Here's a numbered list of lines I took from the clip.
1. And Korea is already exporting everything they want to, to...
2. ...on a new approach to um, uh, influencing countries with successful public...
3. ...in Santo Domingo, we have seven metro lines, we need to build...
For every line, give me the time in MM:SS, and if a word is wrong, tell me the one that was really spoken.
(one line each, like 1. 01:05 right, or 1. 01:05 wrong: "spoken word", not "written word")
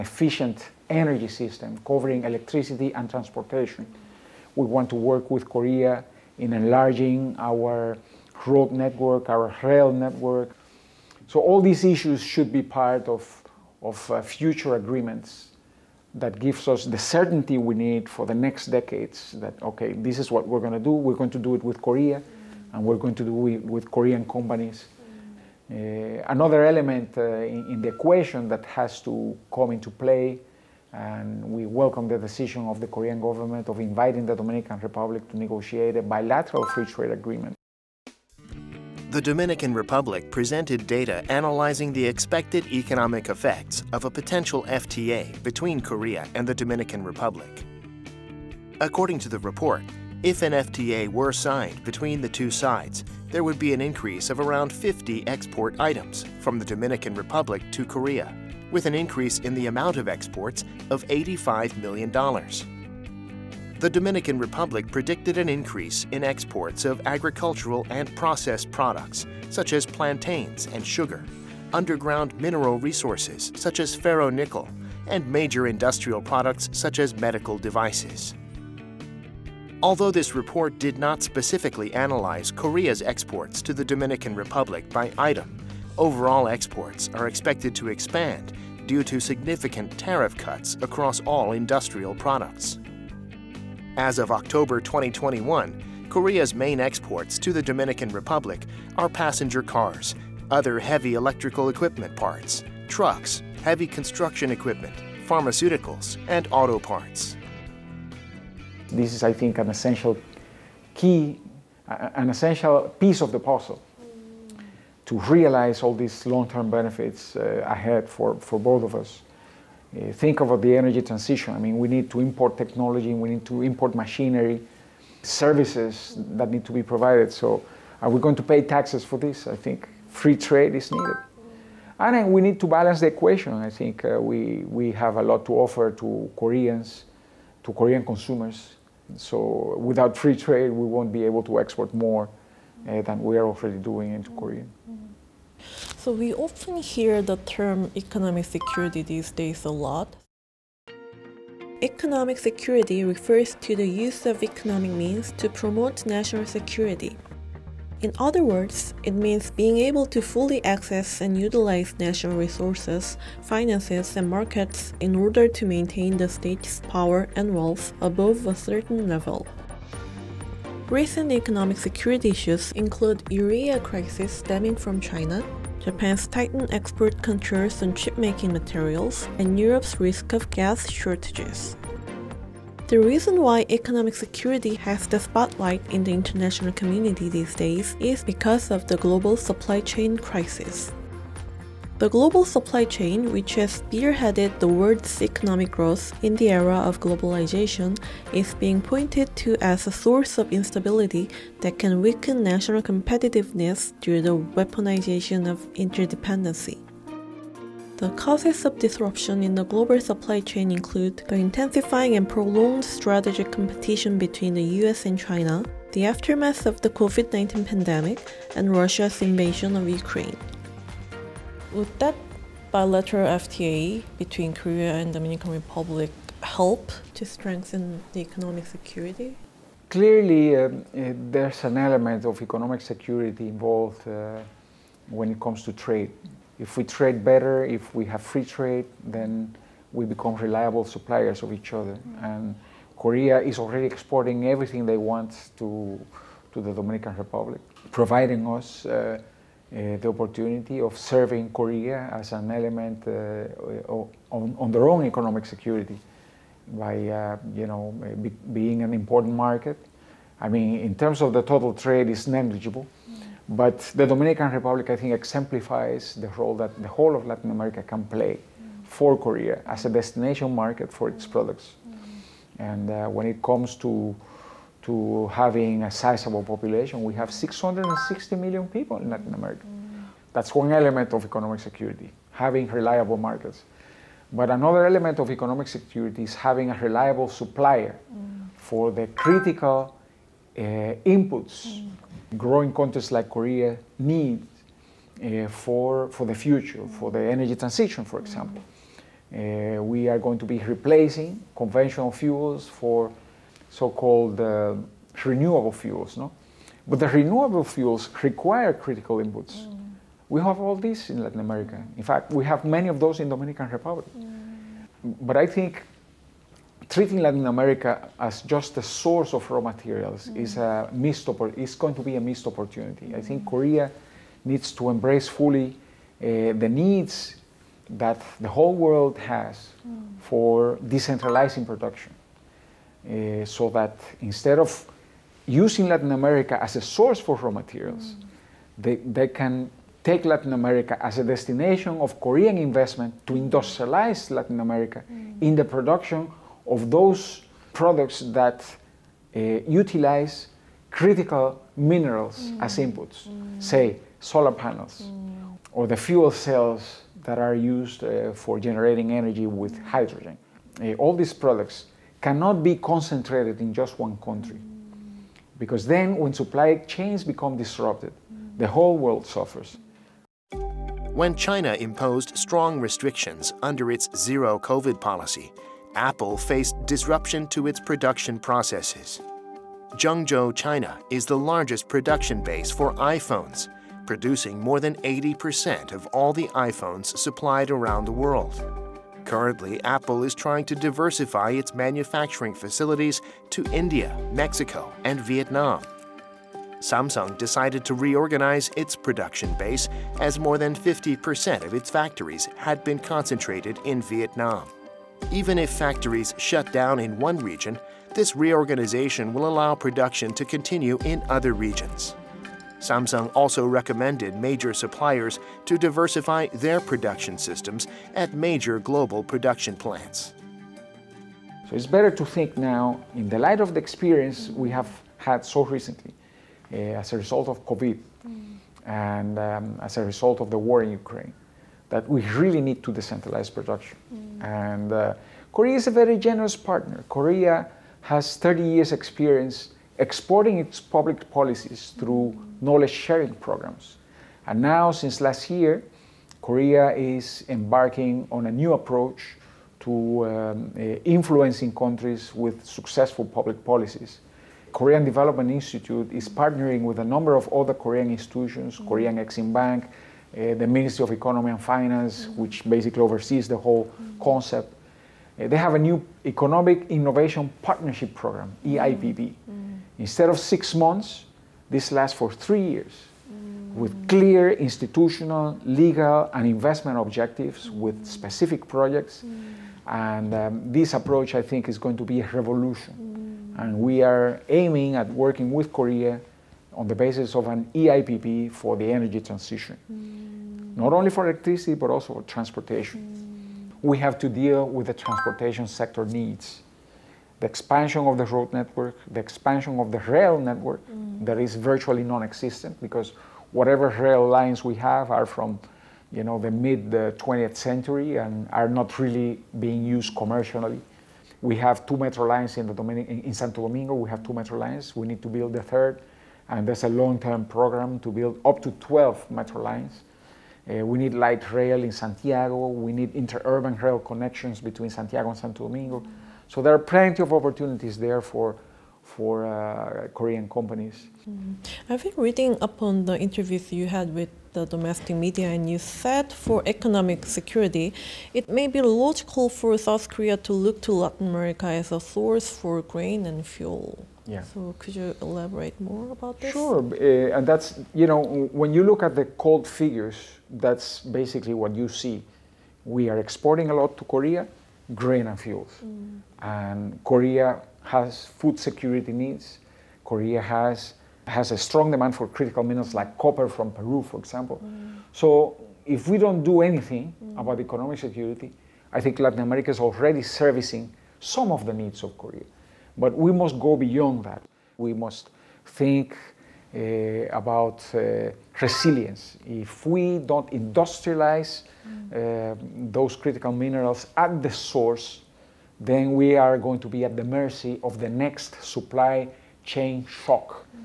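1. 04:02 right
2. 07:28 right
3. 08:32 wrong: "two", not "seven".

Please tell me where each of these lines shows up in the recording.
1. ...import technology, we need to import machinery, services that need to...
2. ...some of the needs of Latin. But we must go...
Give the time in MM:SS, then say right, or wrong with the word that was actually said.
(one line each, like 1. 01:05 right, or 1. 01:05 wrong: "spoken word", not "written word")
1. 02:02 right
2. 09:31 wrong: "Korea", not "Latin".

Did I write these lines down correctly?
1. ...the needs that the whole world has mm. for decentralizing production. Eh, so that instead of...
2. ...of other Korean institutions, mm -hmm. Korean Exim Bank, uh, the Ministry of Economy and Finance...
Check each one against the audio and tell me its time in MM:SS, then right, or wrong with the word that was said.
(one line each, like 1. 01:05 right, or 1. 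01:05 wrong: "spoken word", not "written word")
1. 05:26 right
2. 07:37 right.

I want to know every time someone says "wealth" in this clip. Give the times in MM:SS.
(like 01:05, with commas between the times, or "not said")
02:47.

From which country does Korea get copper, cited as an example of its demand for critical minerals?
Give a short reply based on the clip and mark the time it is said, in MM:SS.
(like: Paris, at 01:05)
Peru, at 09:23.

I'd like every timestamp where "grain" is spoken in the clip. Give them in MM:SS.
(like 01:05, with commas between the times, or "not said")
09:02, 09:14.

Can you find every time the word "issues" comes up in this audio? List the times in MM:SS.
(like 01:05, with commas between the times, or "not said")
00:11, 02:52.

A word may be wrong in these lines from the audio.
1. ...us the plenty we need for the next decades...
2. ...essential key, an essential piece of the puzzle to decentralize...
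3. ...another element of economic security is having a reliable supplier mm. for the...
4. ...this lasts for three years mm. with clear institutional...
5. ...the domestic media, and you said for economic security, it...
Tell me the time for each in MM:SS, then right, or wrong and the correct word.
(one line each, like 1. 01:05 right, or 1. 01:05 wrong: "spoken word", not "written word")
1. 00:16 wrong: "certainty", not "plenty"
2. 01:49 wrong: "realize", not "decentralize"
3. 04:44 right
4. 07:51 right
5. 08:54 right.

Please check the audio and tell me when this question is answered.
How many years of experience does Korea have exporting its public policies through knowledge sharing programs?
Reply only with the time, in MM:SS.
07:18.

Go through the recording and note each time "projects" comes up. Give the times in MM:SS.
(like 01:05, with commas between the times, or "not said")
07:58.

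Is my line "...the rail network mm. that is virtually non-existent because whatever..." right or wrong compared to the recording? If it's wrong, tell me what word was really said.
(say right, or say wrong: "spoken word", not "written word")
right.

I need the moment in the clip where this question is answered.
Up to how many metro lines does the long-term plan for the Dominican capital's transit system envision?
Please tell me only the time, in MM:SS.
08:38.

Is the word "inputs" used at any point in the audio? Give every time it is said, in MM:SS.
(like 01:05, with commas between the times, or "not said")
04:51, 05:09, 05:52.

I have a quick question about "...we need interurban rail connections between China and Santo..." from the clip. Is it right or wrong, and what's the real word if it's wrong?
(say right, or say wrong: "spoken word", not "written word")
wrong: "Santiago", not "China".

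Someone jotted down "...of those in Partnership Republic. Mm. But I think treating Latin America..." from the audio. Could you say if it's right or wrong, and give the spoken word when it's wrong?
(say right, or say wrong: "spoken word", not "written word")
wrong: "Dominican", not "Partnership".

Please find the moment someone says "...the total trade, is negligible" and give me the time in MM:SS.
04:21.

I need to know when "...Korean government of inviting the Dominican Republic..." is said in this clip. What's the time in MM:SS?
00:32.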